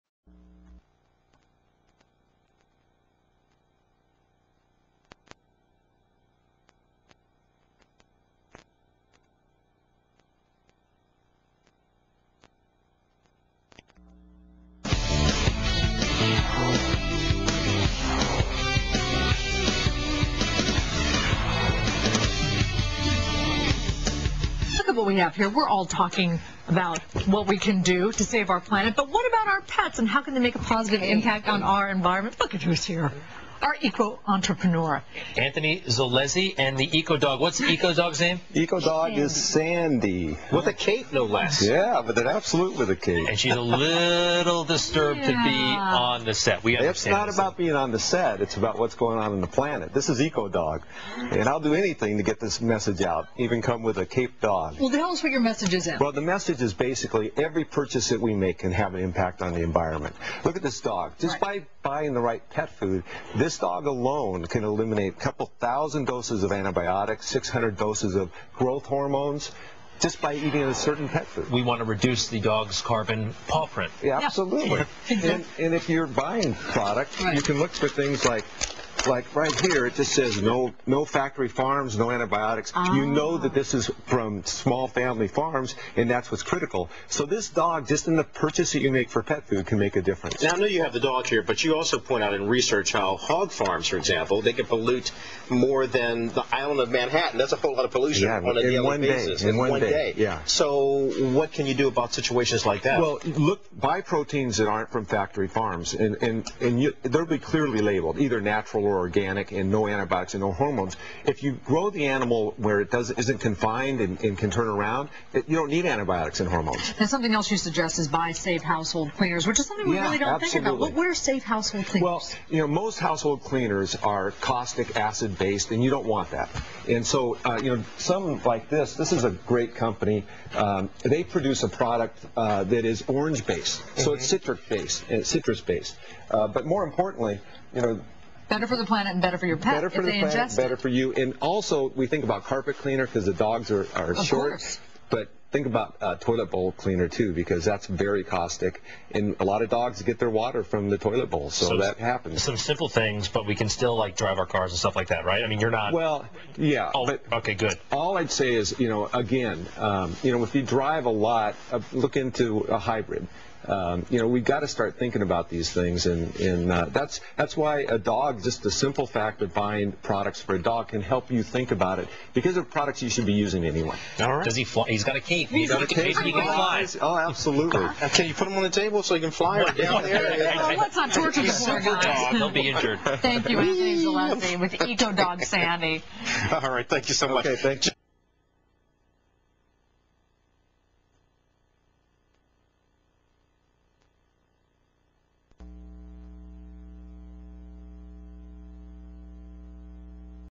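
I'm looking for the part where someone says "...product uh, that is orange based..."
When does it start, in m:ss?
2:11.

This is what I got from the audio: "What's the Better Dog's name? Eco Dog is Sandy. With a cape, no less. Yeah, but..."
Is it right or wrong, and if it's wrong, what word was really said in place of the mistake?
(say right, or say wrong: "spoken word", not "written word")
wrong: "Eco", not "Better".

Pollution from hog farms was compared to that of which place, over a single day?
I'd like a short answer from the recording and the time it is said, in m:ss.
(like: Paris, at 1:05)
Manhattan, at 1:36.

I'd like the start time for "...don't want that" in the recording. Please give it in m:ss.
2:05.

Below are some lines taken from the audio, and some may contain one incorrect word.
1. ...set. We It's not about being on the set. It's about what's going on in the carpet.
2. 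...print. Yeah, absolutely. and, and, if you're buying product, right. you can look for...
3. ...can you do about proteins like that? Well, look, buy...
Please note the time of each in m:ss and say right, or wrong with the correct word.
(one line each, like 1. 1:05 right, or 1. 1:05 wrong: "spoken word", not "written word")
1. 0:46 wrong: "planet", not "carpet"
2. 1:13 right
3. 1:41 wrong: "situations", not "proteins".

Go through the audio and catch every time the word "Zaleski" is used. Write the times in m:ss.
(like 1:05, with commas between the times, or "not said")
3:03.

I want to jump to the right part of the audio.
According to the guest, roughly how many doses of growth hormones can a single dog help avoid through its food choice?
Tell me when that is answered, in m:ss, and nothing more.
1:07.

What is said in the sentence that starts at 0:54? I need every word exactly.
Well, tell us what your message is.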